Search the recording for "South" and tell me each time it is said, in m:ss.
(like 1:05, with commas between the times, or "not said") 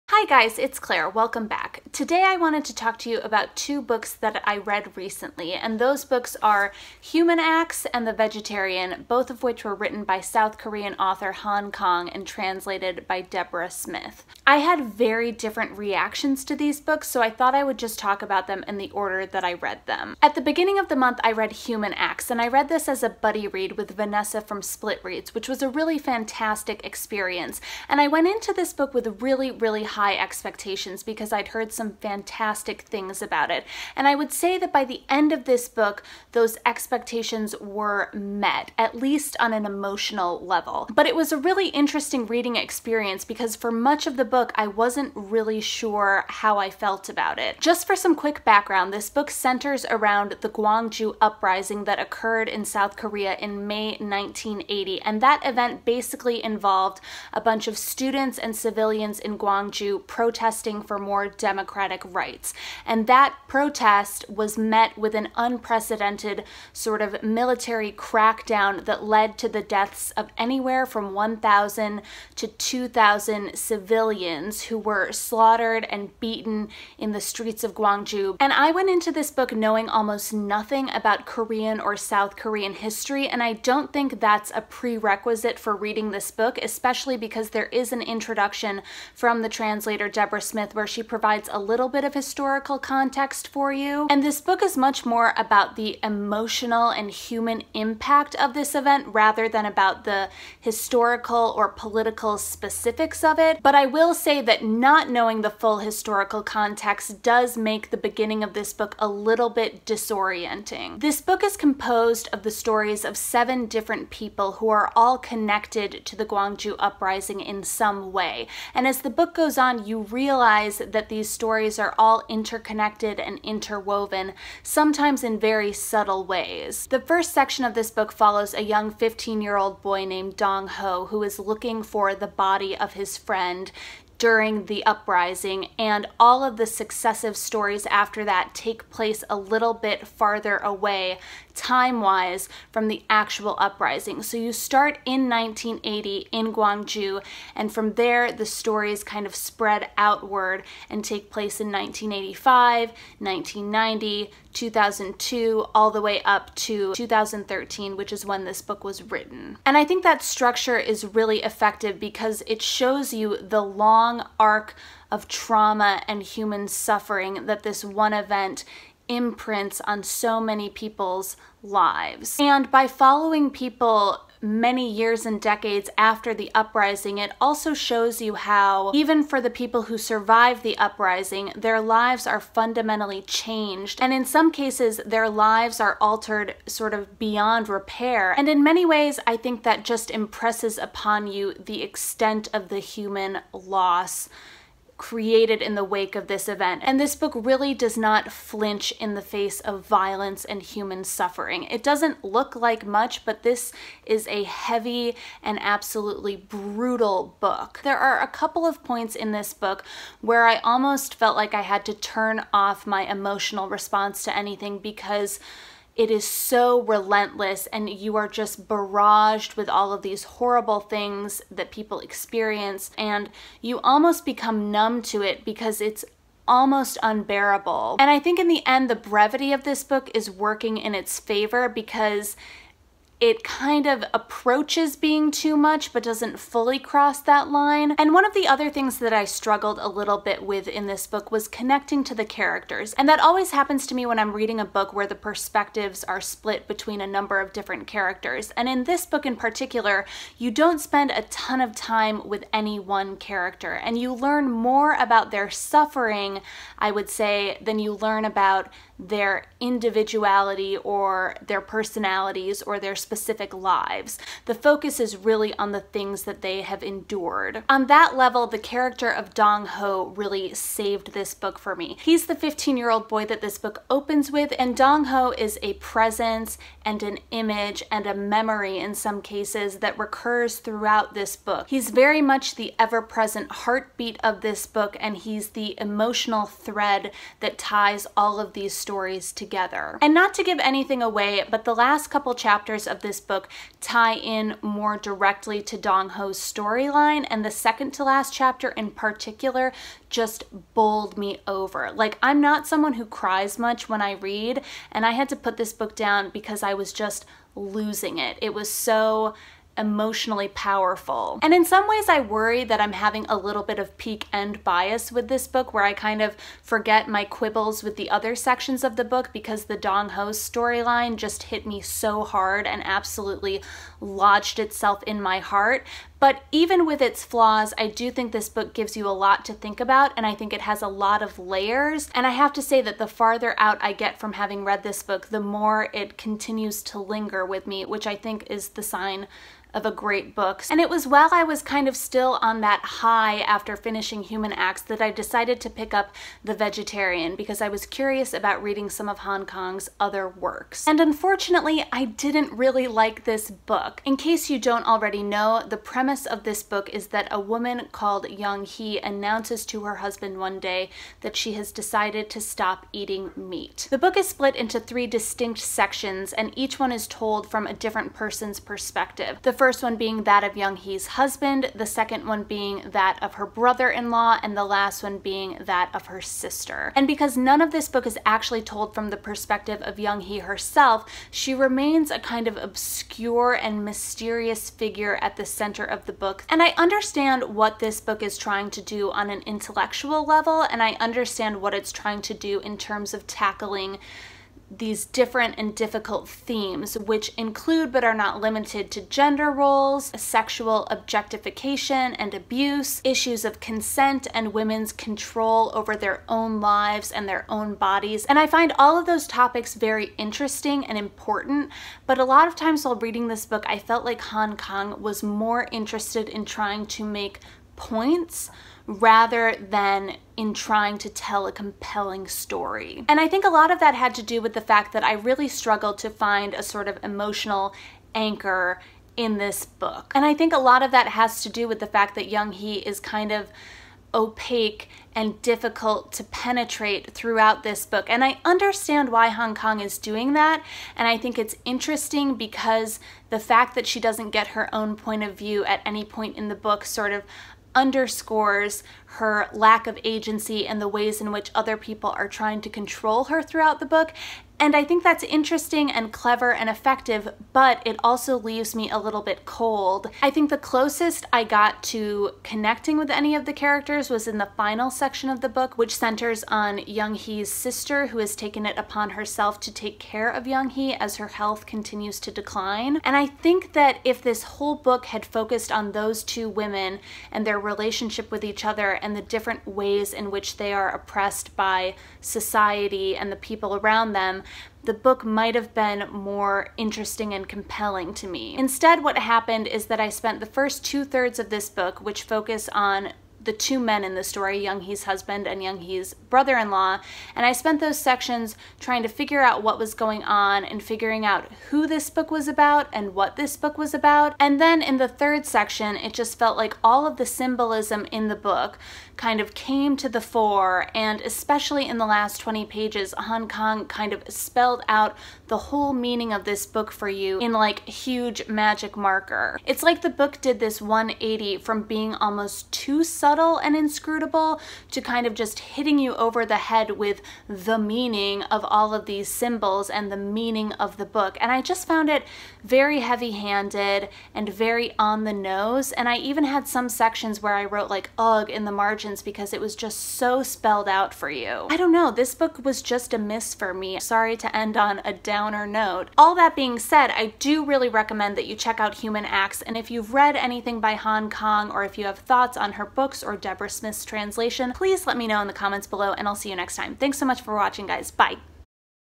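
0:10, 0:52, 1:21.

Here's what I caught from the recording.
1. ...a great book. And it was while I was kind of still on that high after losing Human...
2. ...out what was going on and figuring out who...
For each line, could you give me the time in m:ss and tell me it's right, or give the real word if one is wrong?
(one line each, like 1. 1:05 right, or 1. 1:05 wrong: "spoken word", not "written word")
1. 5:39 wrong: "finishing", not "losing"
2. 8:19 right.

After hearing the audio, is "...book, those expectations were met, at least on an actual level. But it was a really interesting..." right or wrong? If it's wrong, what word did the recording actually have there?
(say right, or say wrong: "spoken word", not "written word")
wrong: "emotional", not "actual".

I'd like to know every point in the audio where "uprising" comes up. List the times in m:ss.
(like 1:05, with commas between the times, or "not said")
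0:51, 1:56, 2:14, 2:23, 2:56, 3:00.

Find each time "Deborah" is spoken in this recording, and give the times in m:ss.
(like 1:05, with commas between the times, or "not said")
0:13, 1:30, 9:13.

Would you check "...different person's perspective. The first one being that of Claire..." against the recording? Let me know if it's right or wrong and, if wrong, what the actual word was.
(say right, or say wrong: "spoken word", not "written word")
wrong: "Young", not "Claire".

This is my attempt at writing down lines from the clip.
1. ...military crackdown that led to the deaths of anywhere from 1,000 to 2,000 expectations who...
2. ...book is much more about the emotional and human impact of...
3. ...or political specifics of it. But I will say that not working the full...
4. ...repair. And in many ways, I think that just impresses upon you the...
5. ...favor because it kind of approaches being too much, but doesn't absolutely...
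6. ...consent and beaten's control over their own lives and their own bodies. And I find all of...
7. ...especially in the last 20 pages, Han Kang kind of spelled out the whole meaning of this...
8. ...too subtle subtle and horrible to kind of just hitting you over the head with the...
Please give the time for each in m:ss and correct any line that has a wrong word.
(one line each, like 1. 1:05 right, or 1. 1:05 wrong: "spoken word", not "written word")
1. 1:07 wrong: "civilians", not "expectations"
2. 1:34 right
3. 1:41 wrong: "knowing", not "working"
4. 3:07 right
5. 3:51 wrong: "fully", not "absolutely"
6. 6:43 wrong: "women", not "beaten"
7. 8:31 right
8. 8:42 wrong: "inscrutable", not "horrible".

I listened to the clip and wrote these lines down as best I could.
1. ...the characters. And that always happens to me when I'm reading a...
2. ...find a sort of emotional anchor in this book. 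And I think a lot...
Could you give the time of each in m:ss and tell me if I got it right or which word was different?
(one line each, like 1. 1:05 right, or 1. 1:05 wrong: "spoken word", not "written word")
1. 4:02 right
2. 7:06 right.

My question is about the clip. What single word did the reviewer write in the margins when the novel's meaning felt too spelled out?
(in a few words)
ugh.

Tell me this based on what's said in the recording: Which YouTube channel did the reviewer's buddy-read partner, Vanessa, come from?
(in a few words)
Split Reads.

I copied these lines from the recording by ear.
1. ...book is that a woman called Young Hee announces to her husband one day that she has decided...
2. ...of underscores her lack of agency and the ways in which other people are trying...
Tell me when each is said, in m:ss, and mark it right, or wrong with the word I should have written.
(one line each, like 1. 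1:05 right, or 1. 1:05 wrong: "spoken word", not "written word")
1. 5:56 right
2. 7:27 right.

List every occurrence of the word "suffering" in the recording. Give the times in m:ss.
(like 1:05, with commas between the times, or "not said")
2:46, 3:21, 4:15.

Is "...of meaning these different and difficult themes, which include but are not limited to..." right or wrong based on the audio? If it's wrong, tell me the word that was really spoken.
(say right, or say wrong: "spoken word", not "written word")
wrong: "tackling", not "meaning".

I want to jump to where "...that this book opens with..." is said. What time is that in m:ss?
4:33.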